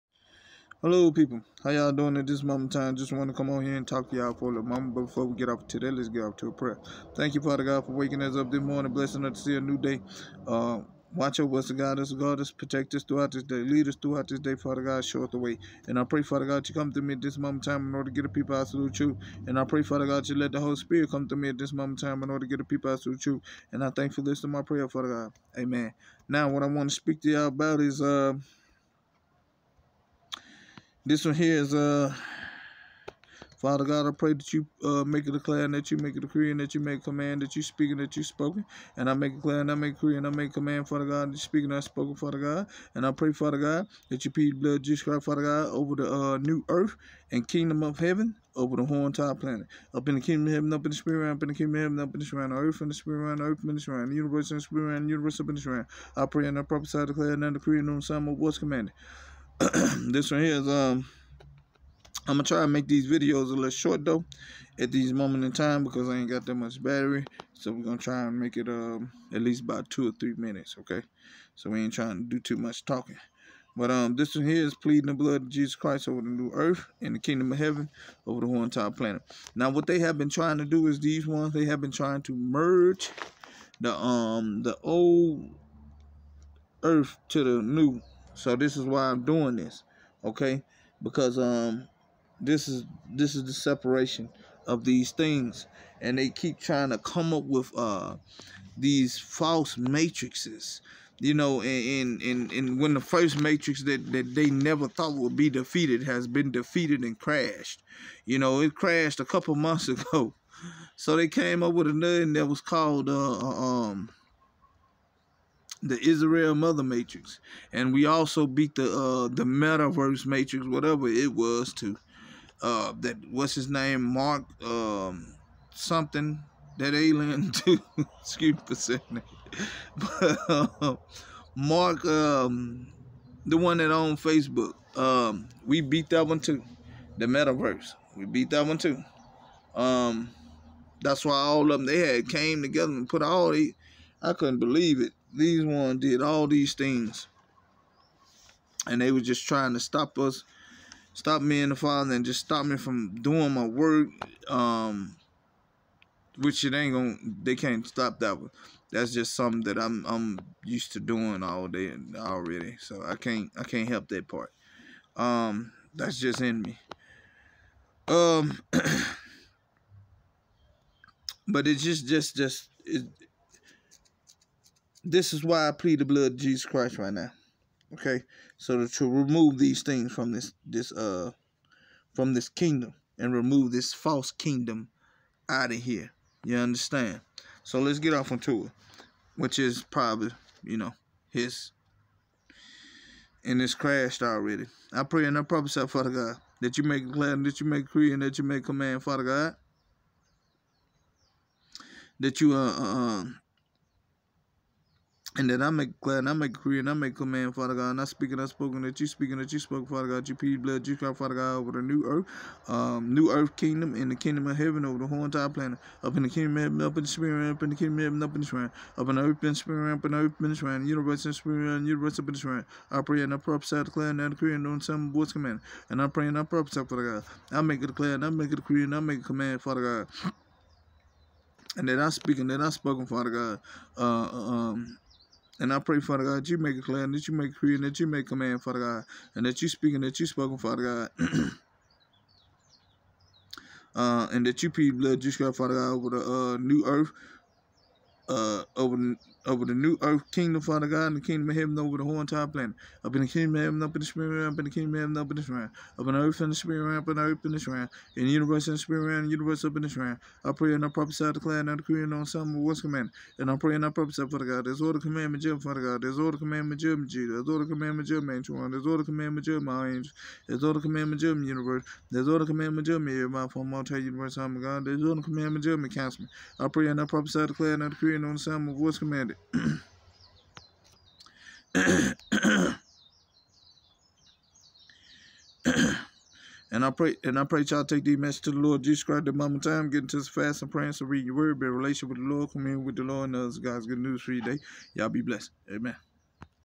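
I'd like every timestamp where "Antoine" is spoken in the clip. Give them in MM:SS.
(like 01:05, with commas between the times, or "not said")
04:28.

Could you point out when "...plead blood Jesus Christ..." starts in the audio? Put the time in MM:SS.
00:44.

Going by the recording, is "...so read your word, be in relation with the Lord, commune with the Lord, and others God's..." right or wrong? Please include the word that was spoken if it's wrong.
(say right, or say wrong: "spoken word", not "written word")
right.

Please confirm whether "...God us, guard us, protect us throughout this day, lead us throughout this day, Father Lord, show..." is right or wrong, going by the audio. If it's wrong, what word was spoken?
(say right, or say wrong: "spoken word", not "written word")
wrong: "God", not "Lord".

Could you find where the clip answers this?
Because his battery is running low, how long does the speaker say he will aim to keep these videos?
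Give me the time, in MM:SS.
01:09.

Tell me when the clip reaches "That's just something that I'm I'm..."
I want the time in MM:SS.
02:38.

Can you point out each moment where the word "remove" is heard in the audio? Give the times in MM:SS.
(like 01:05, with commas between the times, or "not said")
02:59, 03:03.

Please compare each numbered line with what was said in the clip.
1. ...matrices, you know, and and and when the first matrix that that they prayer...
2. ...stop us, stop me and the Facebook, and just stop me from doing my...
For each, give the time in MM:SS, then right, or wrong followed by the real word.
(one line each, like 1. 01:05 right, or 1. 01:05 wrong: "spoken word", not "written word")
1. 01:39 wrong: "never", not "prayer"
2. 02:29 wrong: "Father", not "Facebook".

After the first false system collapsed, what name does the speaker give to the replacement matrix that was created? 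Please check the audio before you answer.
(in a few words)
Israel Mother Matrix.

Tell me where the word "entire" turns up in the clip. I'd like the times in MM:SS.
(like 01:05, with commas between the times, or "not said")
00:49, 01:18, 03:35, 04:12.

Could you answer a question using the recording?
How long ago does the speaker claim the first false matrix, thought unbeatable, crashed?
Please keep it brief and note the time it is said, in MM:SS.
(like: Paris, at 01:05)
A couple months, at 01:49.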